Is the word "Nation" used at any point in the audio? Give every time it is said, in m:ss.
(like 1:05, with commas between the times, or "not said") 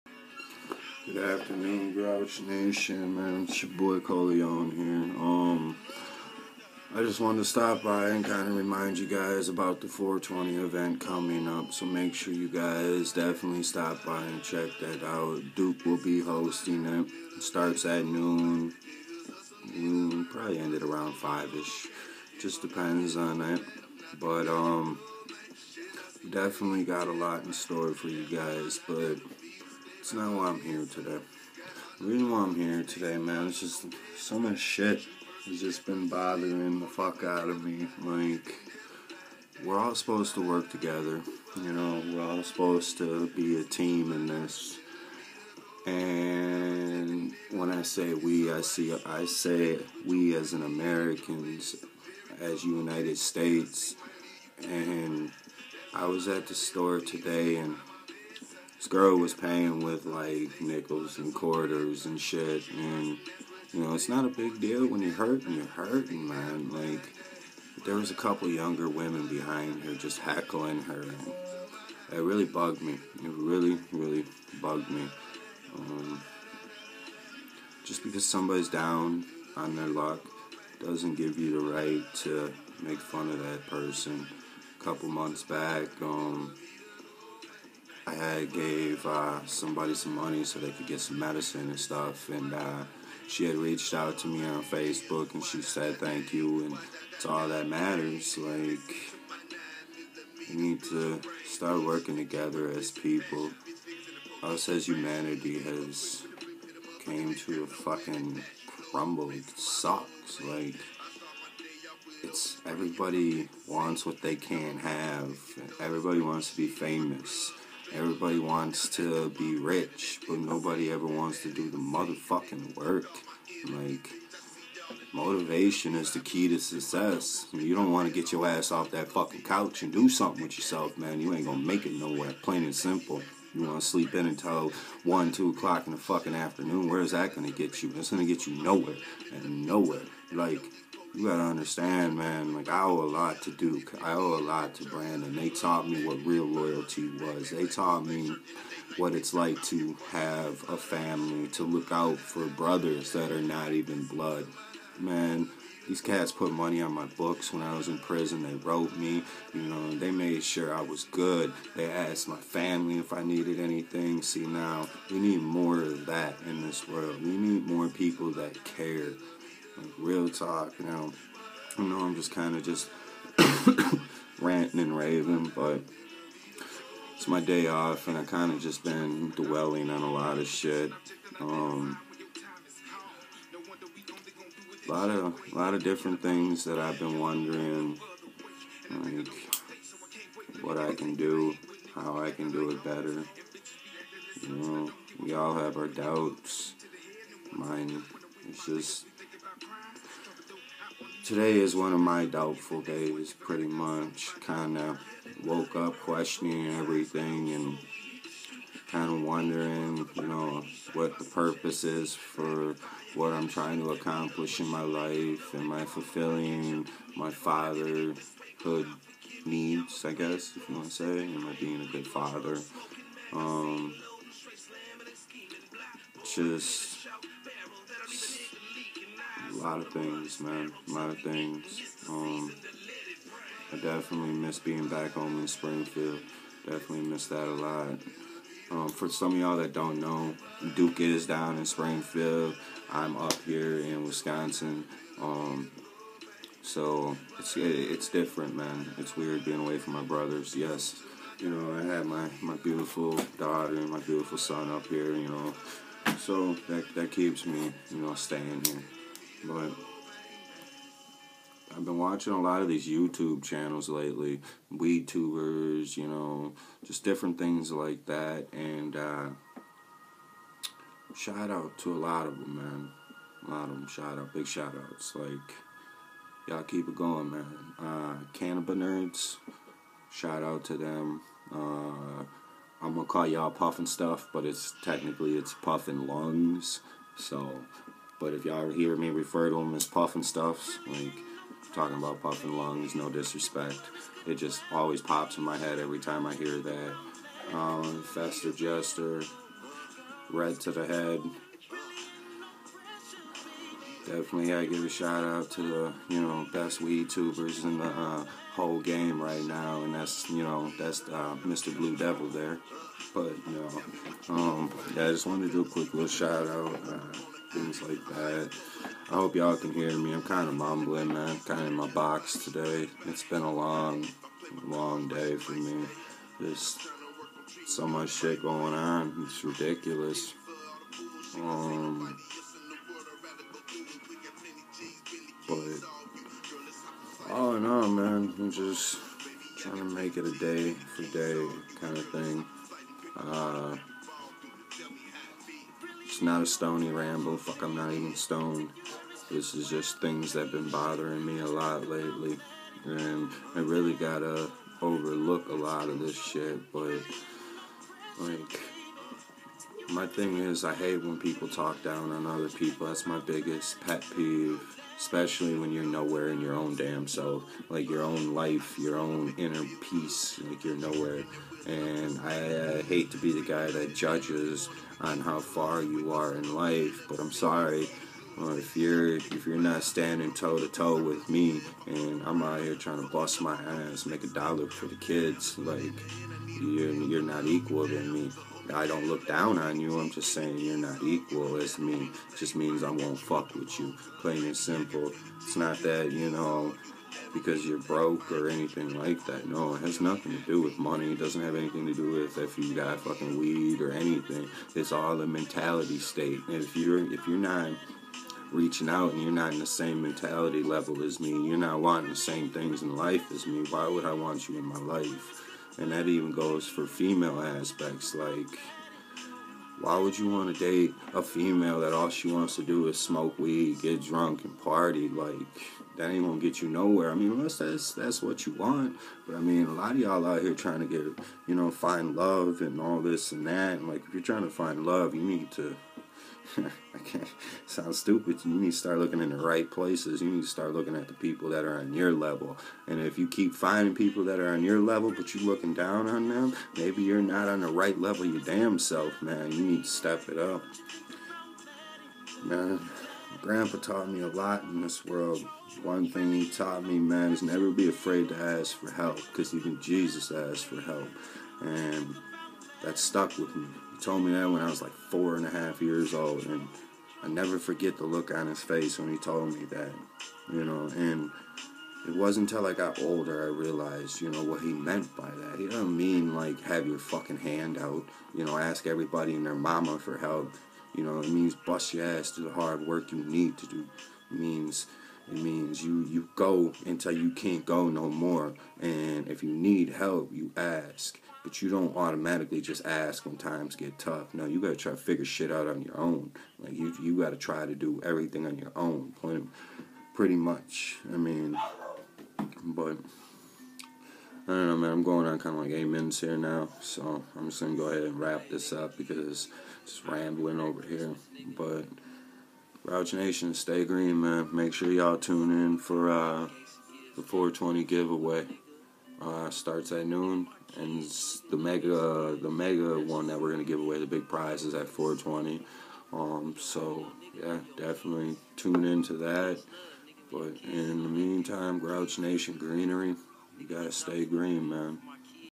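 0:02, 8:33, 8:52.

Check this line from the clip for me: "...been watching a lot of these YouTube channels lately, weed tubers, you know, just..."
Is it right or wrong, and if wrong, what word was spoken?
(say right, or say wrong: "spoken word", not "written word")
right.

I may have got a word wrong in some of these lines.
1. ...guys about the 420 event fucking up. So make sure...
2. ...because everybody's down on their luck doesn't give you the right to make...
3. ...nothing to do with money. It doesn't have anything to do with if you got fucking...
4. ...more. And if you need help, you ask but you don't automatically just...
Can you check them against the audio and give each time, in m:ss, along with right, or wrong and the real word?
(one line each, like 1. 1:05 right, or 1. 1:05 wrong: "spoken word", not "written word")
1. 0:09 wrong: "coming", not "fucking"
2. 1:18 wrong: "somebody", not "everybody"
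3. 6:39 right
4. 8:08 right.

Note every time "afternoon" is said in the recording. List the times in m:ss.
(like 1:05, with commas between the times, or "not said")
0:01, 2:16.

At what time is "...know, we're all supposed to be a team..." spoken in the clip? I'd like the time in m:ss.
0:41.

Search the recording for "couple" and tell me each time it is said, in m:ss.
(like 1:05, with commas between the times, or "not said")
1:08, 1:24.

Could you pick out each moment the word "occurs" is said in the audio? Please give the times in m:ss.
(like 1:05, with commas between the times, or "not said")
not said.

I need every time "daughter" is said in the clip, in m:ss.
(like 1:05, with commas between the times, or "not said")
4:13.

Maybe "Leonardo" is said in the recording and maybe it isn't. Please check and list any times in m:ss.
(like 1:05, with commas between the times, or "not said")
not said.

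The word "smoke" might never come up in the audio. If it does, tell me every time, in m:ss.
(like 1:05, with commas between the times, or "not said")
7:02.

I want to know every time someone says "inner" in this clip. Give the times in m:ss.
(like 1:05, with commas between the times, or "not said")
6:09.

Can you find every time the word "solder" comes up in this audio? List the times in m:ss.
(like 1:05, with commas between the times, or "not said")
not said.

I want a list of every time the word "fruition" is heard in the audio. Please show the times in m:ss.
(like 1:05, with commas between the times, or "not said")
not said.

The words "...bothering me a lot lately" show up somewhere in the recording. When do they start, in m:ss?
5:50.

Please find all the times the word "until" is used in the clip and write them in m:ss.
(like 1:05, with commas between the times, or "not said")
2:14, 7:52, 8:06.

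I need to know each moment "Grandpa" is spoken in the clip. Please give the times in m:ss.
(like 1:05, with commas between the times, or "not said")
7:33.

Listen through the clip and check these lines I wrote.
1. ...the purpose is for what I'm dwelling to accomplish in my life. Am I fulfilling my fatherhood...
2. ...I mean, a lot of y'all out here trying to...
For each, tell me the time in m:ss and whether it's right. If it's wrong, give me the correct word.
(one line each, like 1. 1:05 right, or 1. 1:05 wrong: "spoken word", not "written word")
1. 3:31 wrong: "trying", not "dwelling"
2. 7:09 right.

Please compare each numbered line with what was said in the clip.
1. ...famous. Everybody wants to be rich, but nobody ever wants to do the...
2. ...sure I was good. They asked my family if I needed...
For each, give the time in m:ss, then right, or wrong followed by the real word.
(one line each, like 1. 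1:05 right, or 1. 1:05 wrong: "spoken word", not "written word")
1. 1:56 right
2. 2:40 right.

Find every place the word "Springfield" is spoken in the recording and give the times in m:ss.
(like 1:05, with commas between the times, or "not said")
3:55, 4:01.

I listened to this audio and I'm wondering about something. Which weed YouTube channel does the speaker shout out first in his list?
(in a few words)
Cannabis Nerds.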